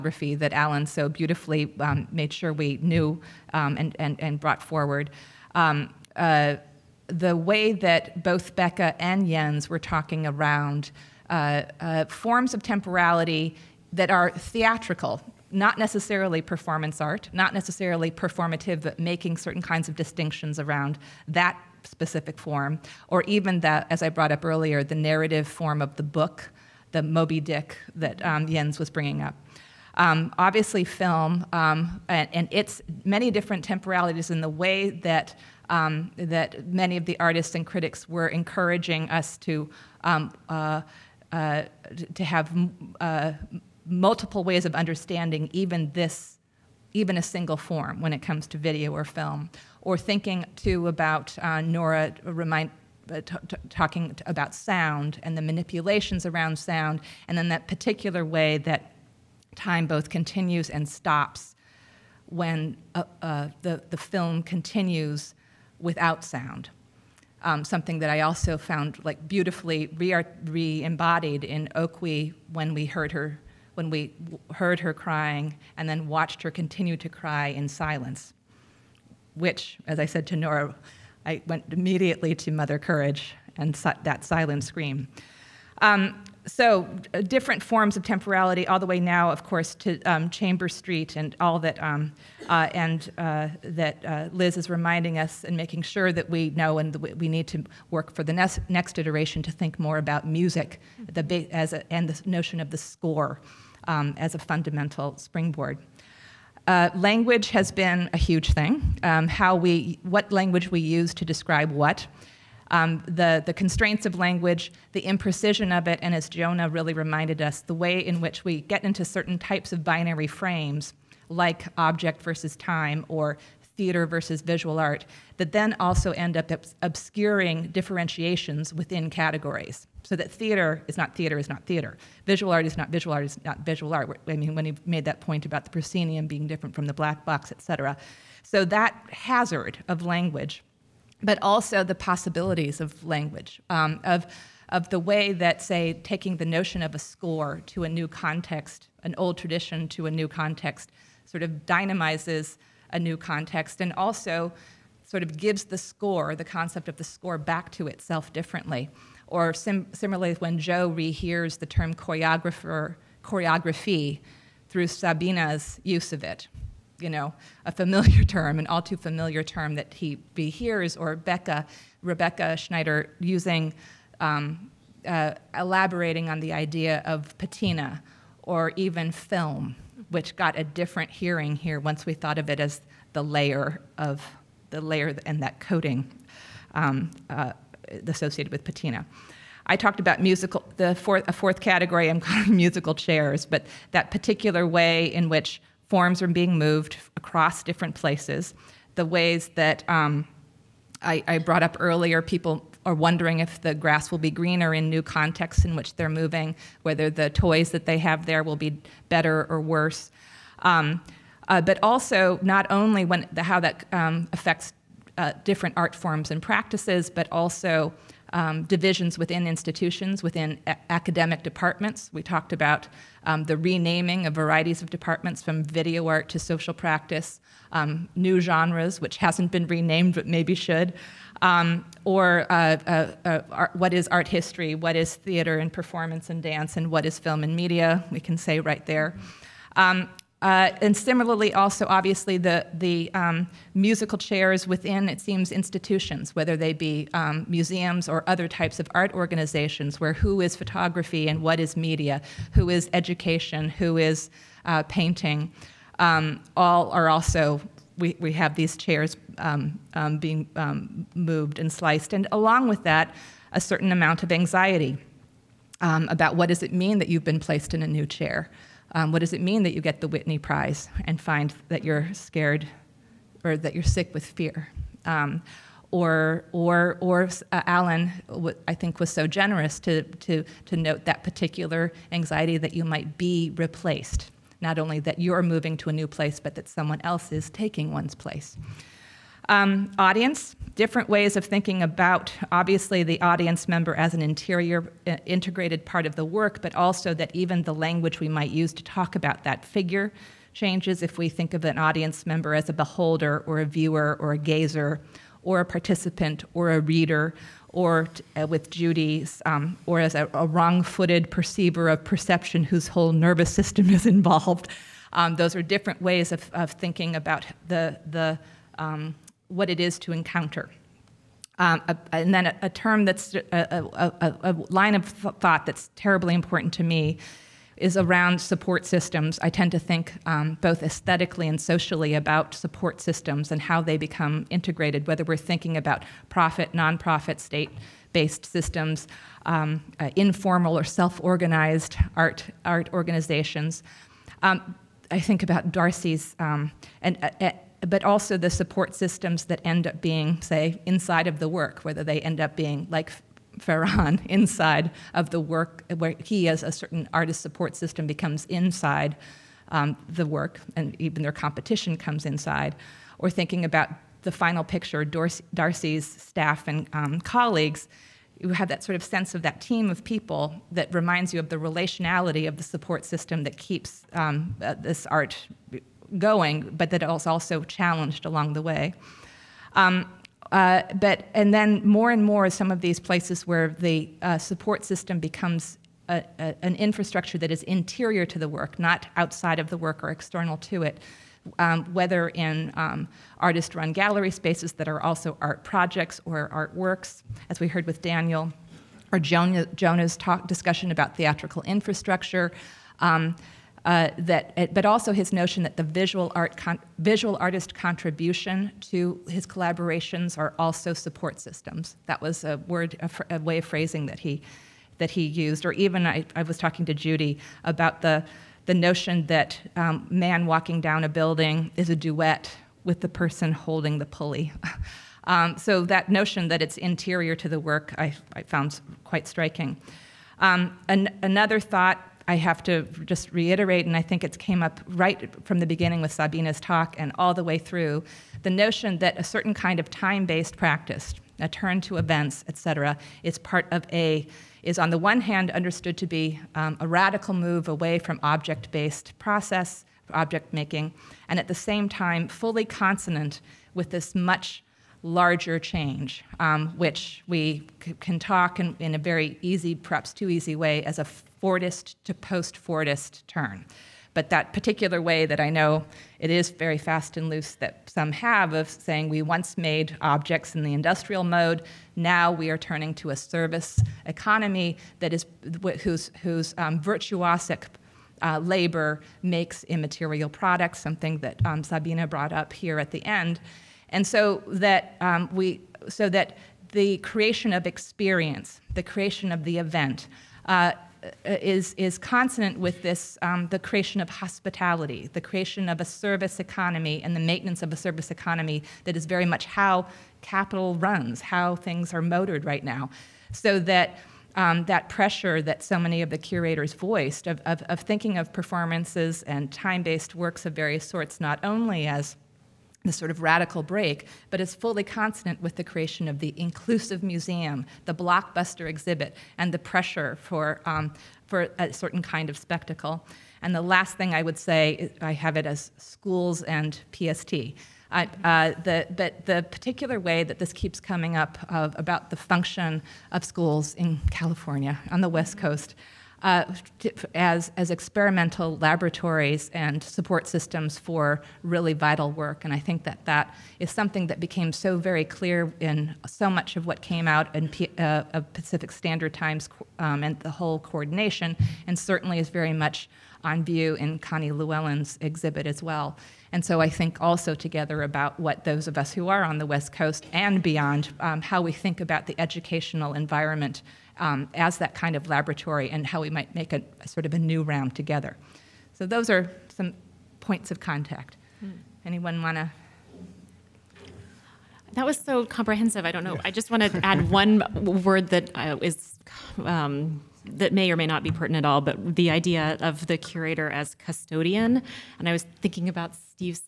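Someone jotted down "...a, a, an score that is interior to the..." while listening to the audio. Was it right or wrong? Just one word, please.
wrong.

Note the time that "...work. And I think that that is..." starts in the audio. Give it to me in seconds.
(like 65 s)
542 s.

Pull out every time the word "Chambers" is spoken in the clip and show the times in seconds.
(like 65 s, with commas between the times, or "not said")
90 s.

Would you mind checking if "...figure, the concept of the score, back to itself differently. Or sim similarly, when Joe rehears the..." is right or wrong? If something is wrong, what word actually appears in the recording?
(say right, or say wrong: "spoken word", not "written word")
wrong: "score", not "figure".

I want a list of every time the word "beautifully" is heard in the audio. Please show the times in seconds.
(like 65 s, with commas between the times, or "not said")
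1 s, 69 s.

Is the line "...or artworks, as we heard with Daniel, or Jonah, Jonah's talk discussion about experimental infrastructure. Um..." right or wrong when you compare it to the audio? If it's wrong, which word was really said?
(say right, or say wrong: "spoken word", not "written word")
wrong: "theatrical", not "experimental".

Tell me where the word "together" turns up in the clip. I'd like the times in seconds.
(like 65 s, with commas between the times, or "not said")
557 s, 567 s.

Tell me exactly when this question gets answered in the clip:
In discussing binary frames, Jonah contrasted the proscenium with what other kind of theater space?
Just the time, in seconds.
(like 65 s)
136 s.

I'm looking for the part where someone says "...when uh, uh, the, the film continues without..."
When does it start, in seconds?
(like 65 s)
62 s.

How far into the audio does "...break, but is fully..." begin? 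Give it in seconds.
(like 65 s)
513 s.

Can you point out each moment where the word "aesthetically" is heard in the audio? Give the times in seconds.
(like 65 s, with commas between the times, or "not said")
330 s.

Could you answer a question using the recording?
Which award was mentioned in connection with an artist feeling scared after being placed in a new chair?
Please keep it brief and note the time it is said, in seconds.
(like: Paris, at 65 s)
the Whitney Prize, at 270 s.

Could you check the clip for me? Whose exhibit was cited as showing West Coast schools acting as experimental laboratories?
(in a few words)
Connie Lewallen.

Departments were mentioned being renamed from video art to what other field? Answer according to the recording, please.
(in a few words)
social practice.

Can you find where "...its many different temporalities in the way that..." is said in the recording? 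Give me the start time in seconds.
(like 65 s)
32 s.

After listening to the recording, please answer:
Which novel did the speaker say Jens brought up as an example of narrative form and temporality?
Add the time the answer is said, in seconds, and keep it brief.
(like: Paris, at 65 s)
Moby Dick, at 27 s.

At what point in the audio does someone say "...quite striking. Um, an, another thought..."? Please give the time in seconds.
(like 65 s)
429 s.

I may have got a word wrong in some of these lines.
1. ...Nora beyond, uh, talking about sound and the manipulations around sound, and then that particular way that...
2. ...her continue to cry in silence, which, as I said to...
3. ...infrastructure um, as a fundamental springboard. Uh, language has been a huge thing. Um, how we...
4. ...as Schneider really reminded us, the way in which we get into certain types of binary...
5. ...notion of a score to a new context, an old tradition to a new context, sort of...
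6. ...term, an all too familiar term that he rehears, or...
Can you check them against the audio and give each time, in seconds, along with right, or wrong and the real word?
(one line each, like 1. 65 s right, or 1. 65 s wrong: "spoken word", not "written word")
1. 51 s wrong: "remind", not "beyond"
2. 76 s right
3. 102 s wrong: "score", not "infrastructure"
4. 116 s wrong: "Jonah", not "Schneider"
5. 146 s right
6. 168 s right.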